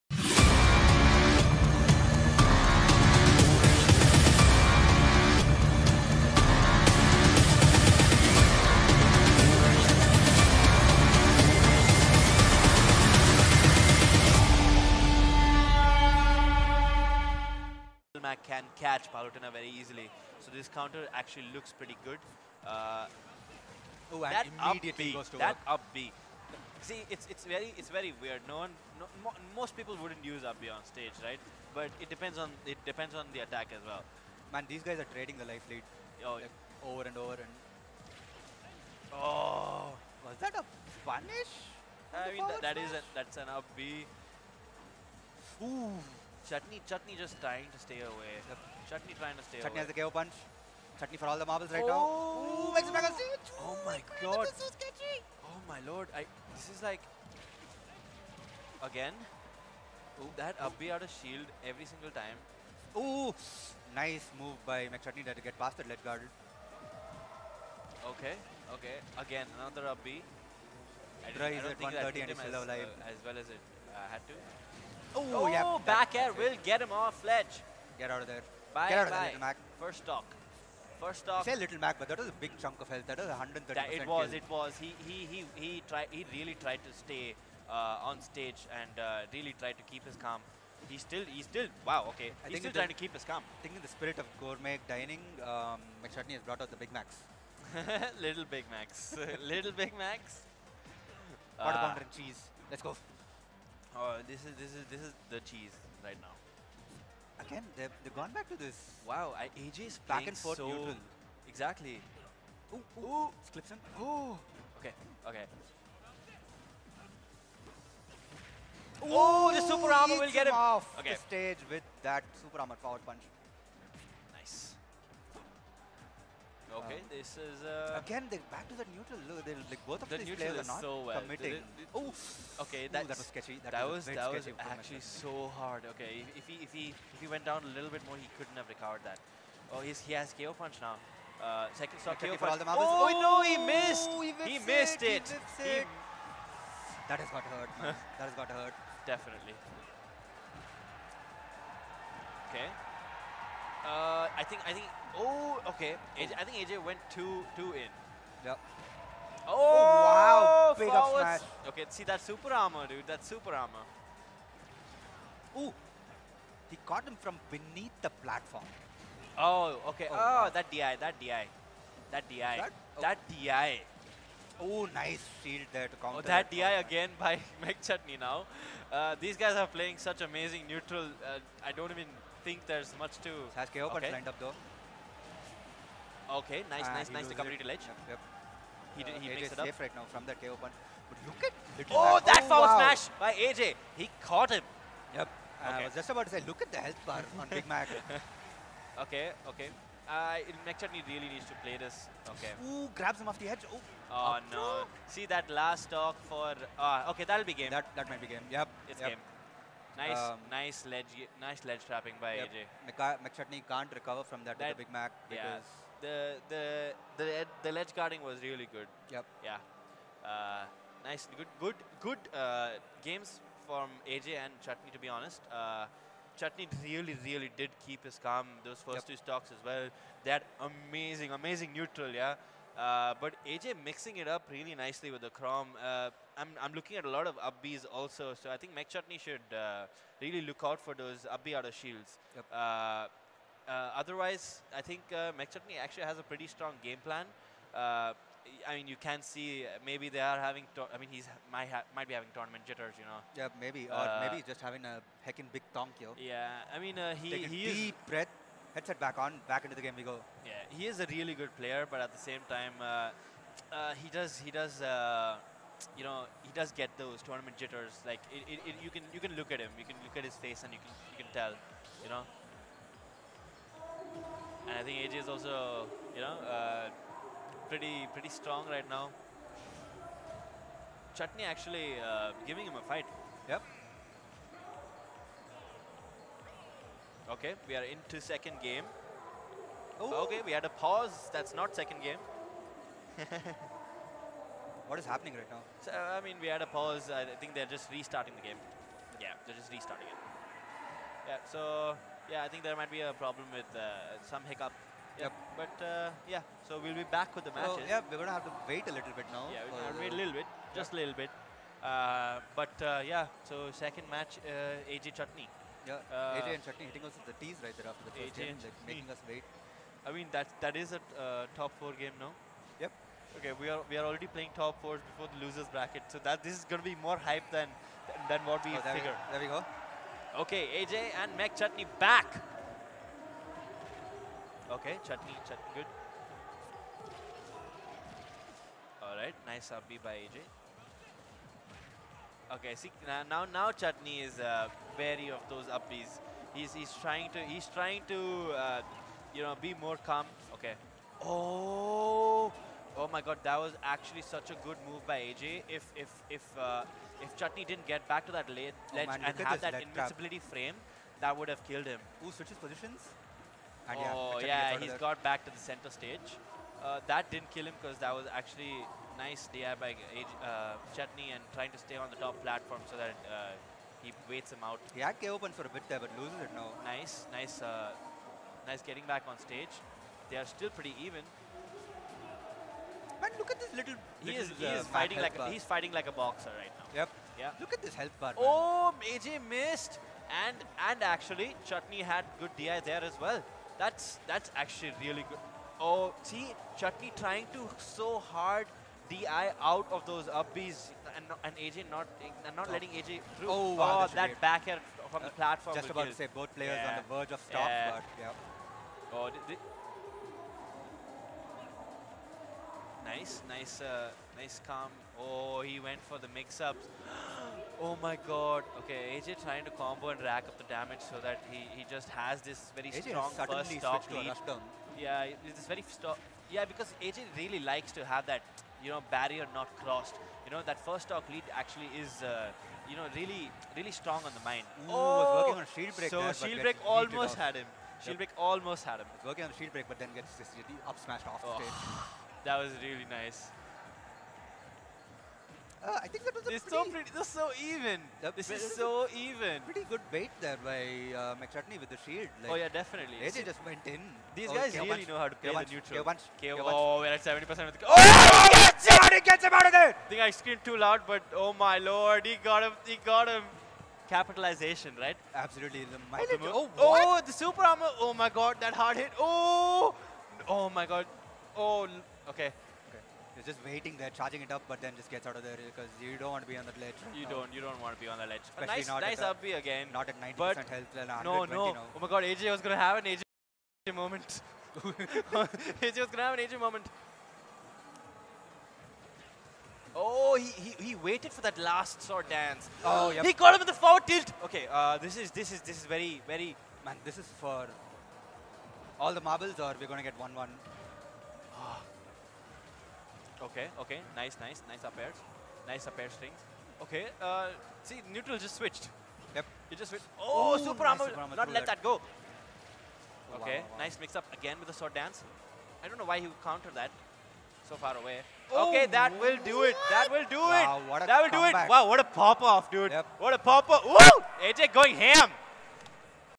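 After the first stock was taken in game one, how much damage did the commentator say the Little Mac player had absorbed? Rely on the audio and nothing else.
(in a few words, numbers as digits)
130.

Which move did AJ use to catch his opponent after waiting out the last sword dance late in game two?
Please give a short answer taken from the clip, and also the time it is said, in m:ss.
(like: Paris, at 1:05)
forward tilt, at 8:13.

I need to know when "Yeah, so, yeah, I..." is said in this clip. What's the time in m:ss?
5:01.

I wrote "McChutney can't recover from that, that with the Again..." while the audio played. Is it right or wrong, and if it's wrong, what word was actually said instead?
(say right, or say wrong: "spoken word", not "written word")
wrong: "Big", not "Again".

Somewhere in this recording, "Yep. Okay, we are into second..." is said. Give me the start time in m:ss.
4:43.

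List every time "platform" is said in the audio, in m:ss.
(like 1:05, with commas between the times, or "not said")
2:48, 6:12, 6:45.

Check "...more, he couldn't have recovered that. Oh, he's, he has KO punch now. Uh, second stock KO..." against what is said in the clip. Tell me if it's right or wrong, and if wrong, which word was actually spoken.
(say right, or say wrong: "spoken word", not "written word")
right.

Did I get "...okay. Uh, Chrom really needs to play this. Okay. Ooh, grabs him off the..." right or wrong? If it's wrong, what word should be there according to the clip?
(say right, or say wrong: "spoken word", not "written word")
wrong: "McChutney", not "Chrom".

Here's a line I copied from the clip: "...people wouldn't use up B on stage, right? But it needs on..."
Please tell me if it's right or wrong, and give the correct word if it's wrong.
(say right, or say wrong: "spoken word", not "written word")
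wrong: "depends", not "needs".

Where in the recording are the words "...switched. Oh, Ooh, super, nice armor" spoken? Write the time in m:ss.
8:29.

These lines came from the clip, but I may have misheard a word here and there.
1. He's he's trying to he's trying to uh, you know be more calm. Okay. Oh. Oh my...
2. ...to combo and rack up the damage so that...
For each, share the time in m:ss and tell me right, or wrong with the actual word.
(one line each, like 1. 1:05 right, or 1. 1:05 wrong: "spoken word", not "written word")
1. 5:46 right
2. 6:59 right.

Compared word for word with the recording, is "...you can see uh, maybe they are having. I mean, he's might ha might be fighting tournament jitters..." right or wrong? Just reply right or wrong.
wrong.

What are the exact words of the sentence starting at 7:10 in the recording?
You know, that first stock lead actually is, uh, you know, really, really strong on the mind.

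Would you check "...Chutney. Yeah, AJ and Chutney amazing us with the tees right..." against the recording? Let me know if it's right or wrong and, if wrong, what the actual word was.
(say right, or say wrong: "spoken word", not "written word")
wrong: "hitting", not "amazing".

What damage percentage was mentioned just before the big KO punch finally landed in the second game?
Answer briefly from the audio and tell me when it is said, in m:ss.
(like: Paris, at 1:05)
70 percent, at 7:37.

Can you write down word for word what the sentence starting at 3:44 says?
To be honest, uh, Chutney really, really did keep his calm those first yep.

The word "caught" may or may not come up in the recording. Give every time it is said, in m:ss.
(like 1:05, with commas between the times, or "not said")
2:46, 3:14, 8:13.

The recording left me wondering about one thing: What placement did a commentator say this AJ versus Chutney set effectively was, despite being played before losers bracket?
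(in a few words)
top four.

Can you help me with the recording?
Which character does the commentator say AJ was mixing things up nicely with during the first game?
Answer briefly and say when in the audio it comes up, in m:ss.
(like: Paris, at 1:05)
Chrom, at 3:55.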